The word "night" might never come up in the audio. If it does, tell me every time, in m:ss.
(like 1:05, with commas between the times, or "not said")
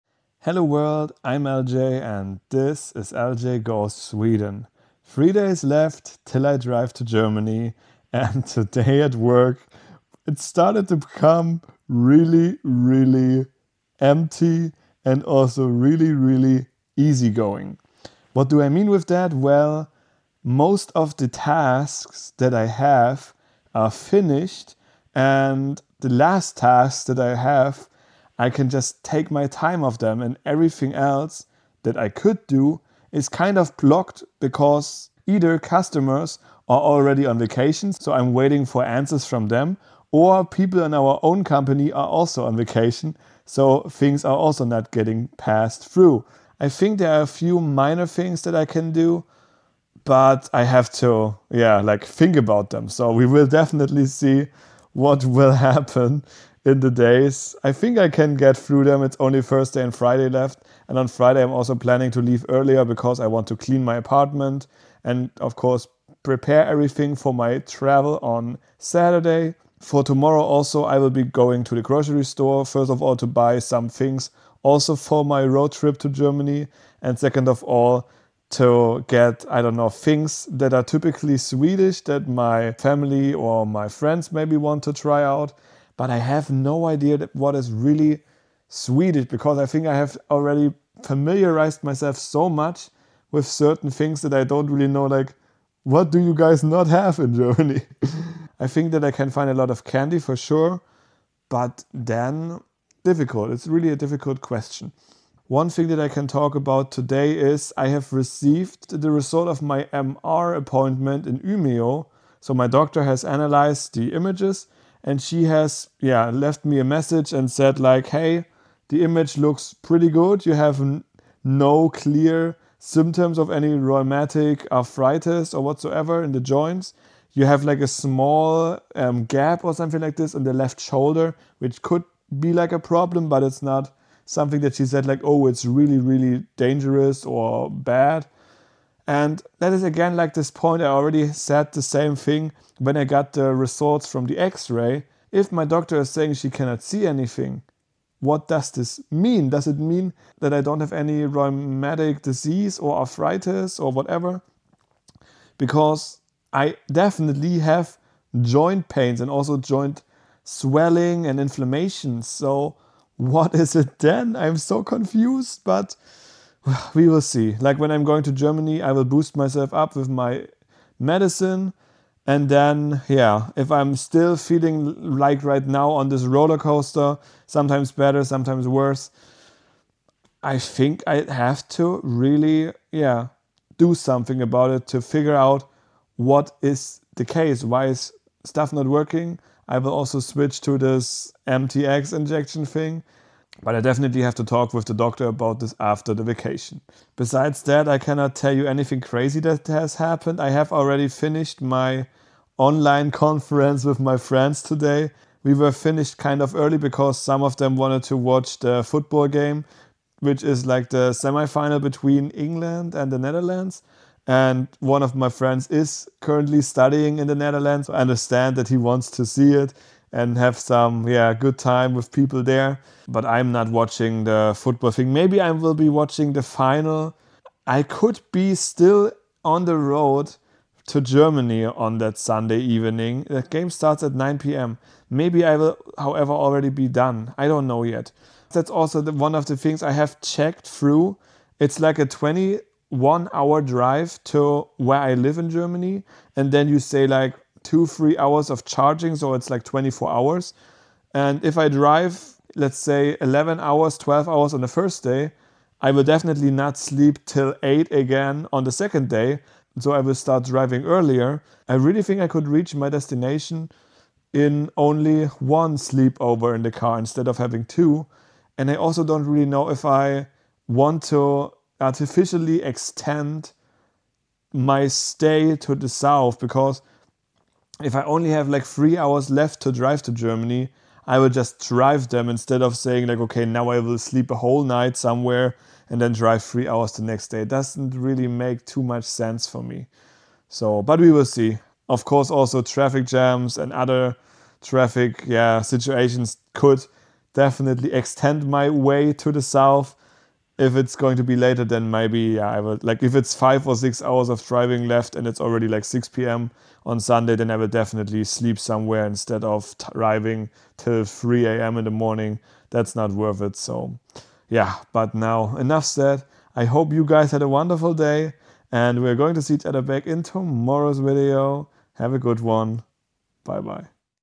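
4:44.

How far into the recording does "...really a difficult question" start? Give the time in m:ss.
1:43.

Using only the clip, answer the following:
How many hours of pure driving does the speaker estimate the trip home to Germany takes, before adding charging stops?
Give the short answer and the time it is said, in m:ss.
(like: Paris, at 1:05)
21, at 4:02.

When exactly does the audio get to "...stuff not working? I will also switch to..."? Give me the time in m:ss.
3:08.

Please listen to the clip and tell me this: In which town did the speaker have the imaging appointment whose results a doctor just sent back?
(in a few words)
Umeå.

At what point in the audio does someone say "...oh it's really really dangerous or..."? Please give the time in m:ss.
2:15.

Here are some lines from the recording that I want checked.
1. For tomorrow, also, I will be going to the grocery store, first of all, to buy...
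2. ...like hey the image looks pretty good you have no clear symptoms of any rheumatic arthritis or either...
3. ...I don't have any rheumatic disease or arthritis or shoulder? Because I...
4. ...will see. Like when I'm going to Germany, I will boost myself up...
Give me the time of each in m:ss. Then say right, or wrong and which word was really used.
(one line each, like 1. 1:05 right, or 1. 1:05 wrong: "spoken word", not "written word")
1. 1:09 right
2. 1:57 wrong: "whatsoever", not "either"
3. 2:30 wrong: "whatever", not "shoulder"
4. 2:47 right.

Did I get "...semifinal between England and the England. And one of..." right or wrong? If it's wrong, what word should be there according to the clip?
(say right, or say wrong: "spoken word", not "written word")
wrong: "Netherlands", not "England".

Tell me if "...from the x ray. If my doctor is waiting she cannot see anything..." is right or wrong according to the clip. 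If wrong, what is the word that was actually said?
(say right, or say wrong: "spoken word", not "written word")
wrong: "saying", not "waiting".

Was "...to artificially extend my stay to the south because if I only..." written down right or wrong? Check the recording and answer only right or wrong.
right.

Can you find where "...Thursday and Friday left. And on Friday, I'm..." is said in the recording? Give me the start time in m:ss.
0:59.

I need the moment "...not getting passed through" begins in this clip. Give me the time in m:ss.
0:44.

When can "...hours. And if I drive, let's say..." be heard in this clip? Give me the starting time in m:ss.
4:10.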